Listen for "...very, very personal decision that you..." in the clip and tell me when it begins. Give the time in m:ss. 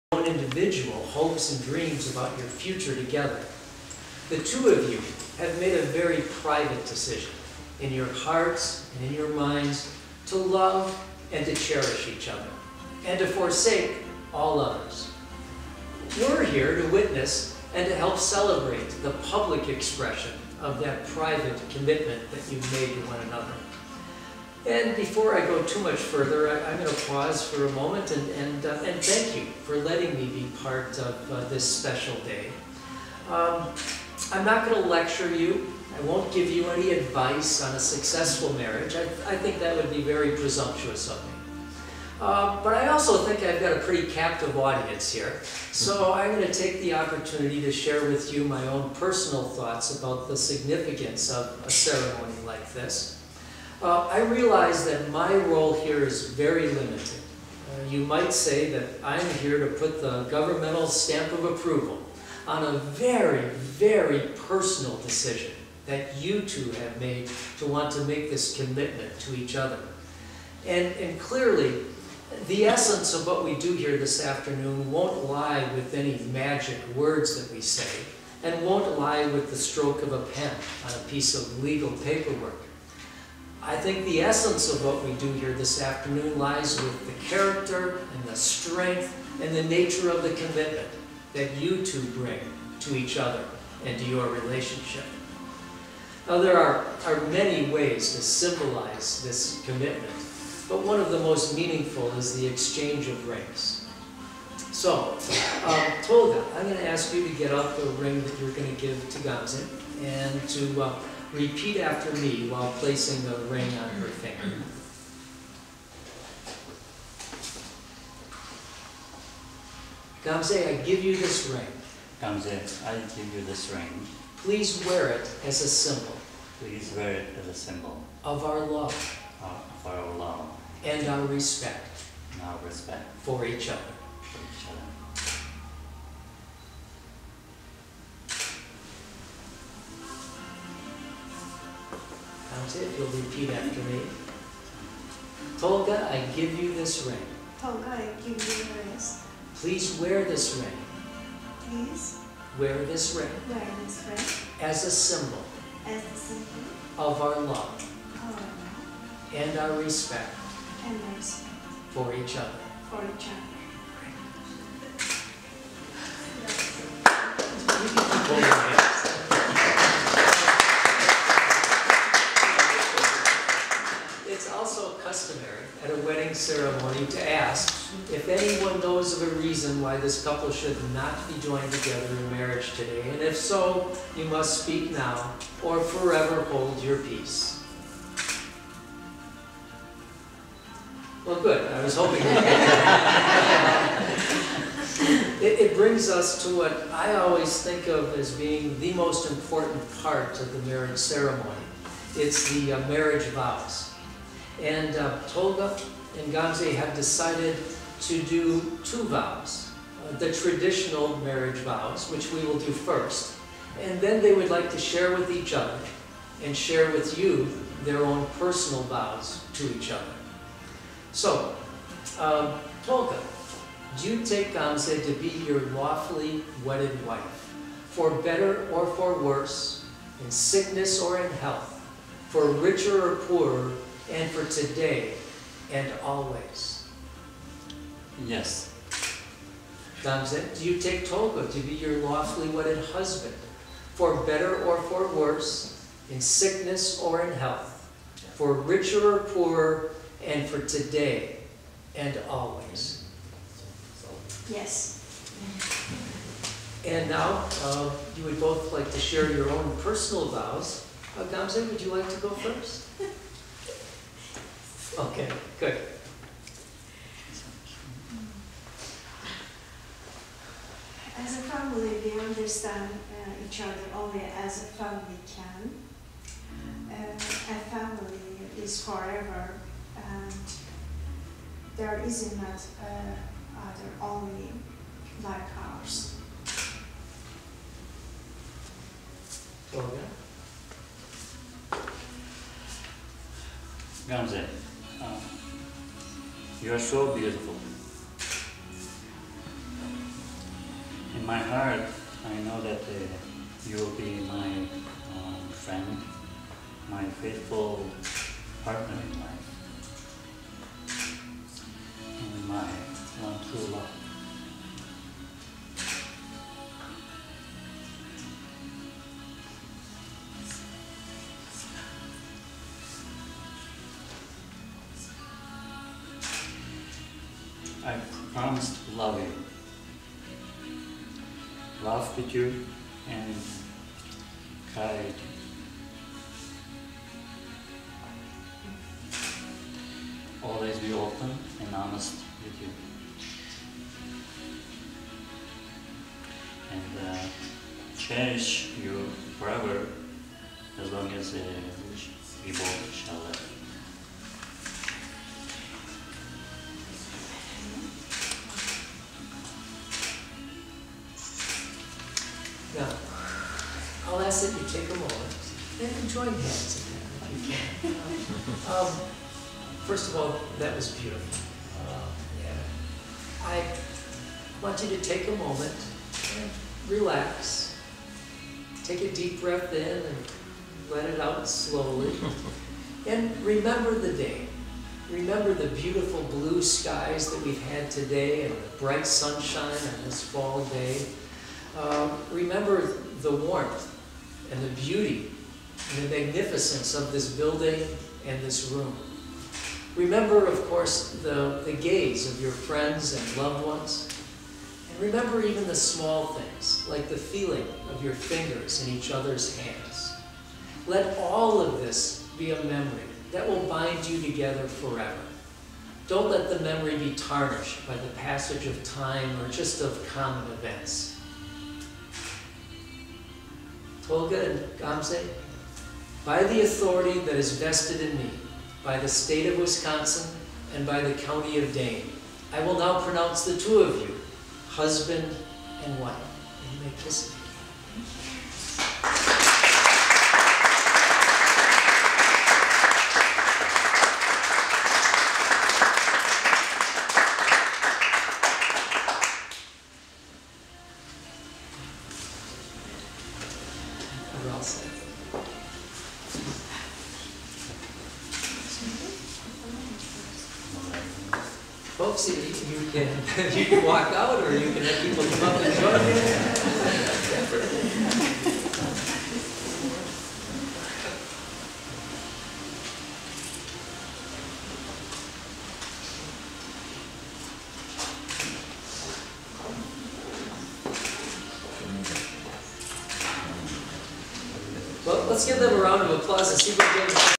1:02.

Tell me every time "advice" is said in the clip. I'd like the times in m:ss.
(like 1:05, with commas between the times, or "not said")
0:36.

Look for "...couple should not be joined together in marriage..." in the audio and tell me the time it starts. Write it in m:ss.
3:00.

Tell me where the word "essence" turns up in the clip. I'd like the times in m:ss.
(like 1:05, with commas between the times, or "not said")
1:12, 1:24.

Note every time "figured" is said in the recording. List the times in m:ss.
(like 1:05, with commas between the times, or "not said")
not said.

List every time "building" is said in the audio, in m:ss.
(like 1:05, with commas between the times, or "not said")
6:37.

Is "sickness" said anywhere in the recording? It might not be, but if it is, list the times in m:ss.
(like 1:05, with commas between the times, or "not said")
3:50, 4:06.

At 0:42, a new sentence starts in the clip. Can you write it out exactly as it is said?
Uh, but I also think I've got a pretty captive audience here.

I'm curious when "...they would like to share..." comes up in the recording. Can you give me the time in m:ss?
3:34.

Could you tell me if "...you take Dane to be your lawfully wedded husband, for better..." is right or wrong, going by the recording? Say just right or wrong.
wrong.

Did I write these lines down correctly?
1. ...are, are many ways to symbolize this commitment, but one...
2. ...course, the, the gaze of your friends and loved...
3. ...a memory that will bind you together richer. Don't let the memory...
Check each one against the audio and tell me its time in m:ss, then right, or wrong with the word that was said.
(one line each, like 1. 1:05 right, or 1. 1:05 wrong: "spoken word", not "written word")
1. 1:36 right
2. 6:40 right
3. 6:52 wrong: "forever", not "richer".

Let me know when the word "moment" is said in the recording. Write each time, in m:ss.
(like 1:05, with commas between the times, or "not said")
0:27, 6:15.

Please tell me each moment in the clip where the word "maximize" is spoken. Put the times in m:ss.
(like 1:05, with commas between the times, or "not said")
not said.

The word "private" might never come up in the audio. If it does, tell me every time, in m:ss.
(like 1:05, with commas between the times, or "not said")
0:06, 0:21.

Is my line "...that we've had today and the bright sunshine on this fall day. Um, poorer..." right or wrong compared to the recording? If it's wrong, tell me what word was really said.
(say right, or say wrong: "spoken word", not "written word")
wrong: "remember", not "poorer".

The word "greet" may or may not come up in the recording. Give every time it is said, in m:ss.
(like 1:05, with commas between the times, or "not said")
not said.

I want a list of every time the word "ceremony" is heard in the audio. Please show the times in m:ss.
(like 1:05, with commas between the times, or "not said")
0:51, 3:20.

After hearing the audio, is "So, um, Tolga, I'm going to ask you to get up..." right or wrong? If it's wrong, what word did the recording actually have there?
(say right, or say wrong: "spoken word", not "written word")
right.